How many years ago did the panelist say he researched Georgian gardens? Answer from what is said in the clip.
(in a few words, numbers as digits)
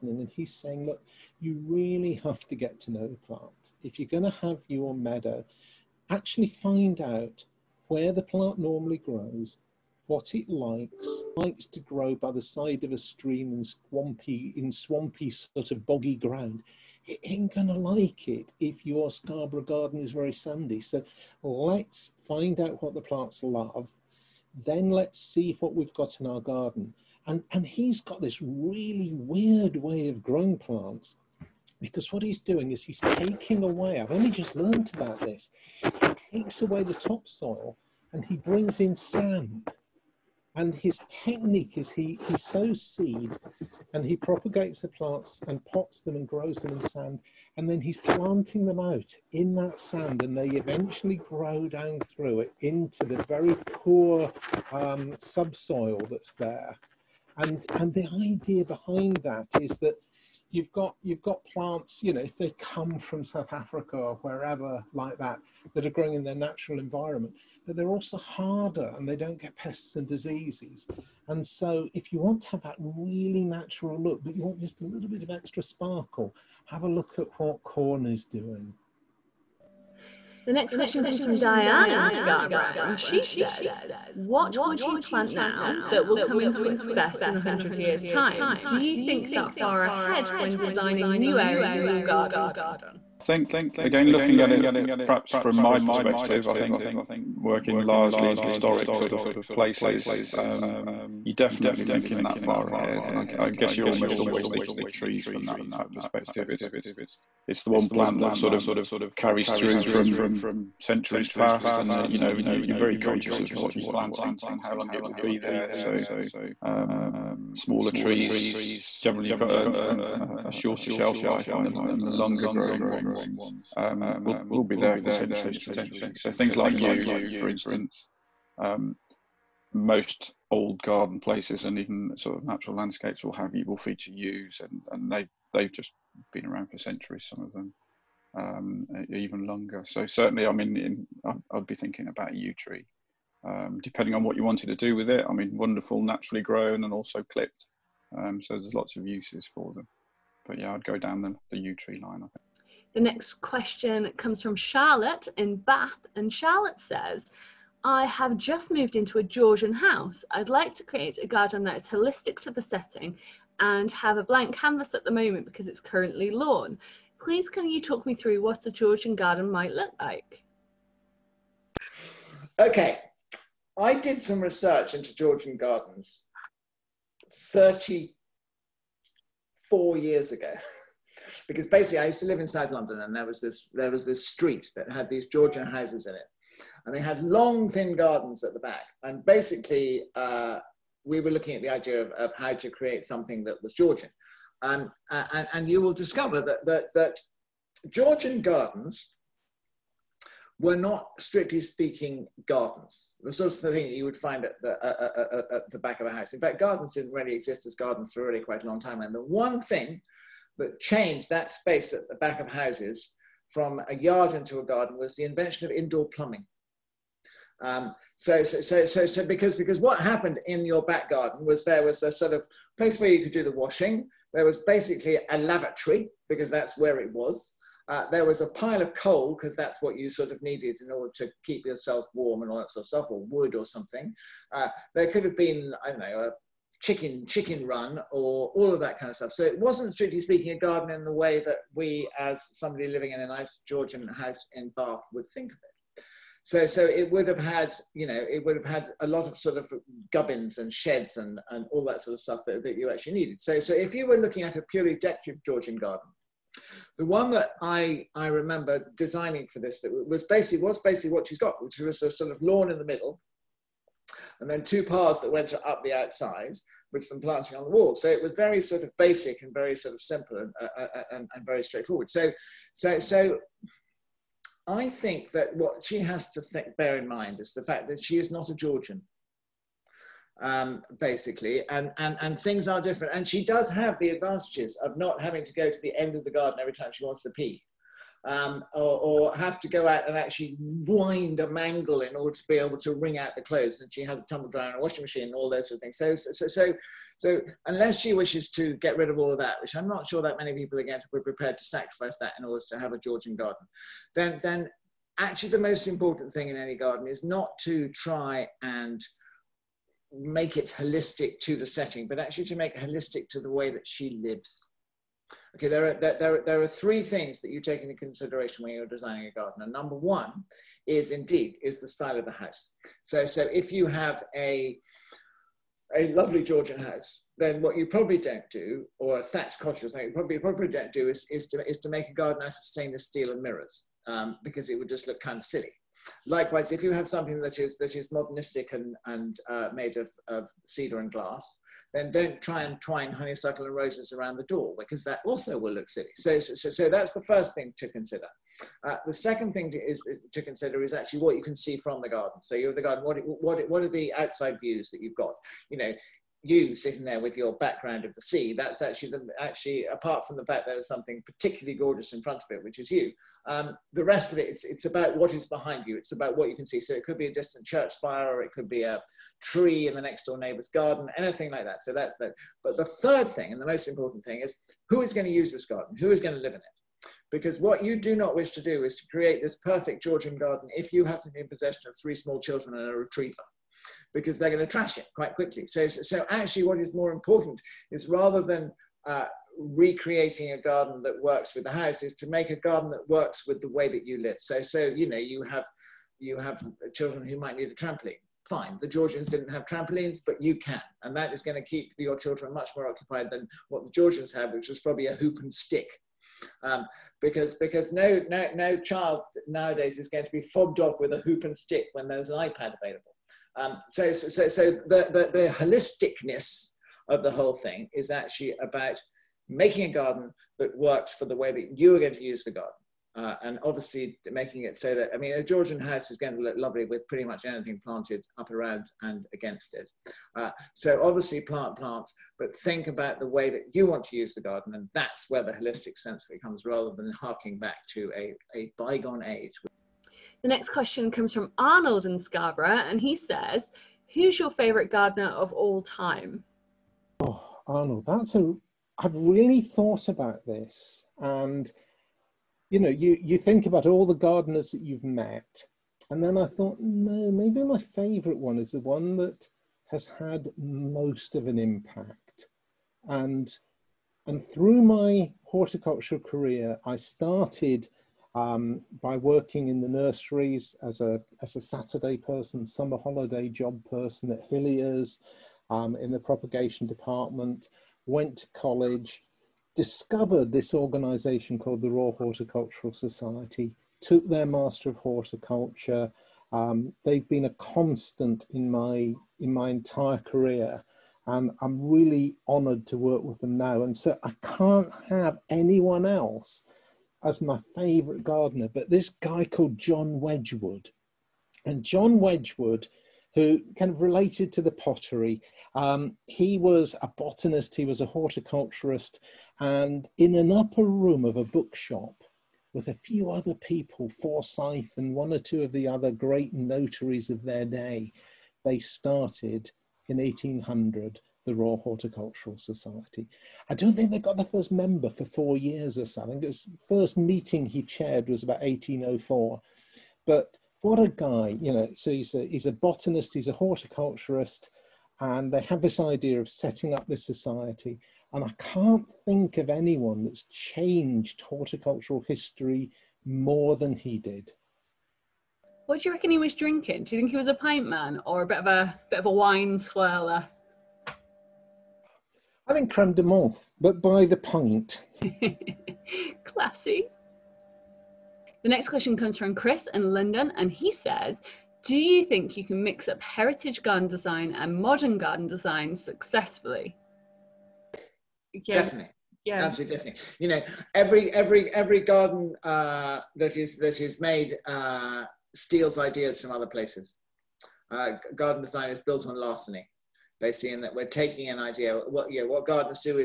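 34.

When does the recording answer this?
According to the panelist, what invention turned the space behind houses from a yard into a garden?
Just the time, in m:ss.
3:35.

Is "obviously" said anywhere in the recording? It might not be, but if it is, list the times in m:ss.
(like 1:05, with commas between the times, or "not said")
7:03, 7:11.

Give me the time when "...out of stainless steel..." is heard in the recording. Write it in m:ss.
5:32.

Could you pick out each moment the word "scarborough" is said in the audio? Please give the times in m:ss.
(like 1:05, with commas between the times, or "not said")
0:19, 1:22, 7:22.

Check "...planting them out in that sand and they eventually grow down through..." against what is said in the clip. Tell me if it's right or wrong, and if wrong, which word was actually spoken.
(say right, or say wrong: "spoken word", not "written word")
right.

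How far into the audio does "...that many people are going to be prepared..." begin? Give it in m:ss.
5:00.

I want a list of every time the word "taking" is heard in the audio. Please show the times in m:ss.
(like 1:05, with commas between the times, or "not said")
0:33, 9:41.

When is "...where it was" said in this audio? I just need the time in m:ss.
3:46.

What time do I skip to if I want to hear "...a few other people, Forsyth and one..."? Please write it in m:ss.
8:32.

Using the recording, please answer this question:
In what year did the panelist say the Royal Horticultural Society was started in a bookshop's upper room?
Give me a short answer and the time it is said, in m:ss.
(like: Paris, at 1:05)
1800, at 8:40.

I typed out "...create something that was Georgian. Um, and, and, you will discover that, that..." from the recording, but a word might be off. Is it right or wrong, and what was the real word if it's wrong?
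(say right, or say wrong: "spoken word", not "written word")
right.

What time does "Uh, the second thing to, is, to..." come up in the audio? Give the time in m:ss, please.
5:48.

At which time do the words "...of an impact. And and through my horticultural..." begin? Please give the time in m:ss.
7:41.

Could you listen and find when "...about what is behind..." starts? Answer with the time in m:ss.
6:04.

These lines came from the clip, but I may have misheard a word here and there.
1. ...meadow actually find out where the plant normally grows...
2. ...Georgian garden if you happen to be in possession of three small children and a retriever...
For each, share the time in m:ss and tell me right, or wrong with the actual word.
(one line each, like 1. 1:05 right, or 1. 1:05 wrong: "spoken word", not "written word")
1. 0:04 right
2. 6:20 right.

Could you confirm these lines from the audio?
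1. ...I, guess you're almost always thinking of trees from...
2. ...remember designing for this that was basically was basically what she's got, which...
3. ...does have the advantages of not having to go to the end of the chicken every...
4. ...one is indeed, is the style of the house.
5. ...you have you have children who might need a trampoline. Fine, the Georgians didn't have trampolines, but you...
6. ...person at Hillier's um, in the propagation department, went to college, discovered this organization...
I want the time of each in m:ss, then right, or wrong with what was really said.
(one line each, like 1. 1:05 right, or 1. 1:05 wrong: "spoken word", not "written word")
1. 1:43 right
2. 4:18 right
3. 4:43 wrong: "garden", not "chicken"
4. 5:19 right
5. 6:35 right
6. 7:53 right.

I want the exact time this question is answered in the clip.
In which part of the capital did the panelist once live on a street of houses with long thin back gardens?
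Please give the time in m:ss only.
3:02.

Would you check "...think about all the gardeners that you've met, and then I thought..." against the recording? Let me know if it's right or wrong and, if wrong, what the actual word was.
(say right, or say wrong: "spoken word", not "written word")
right.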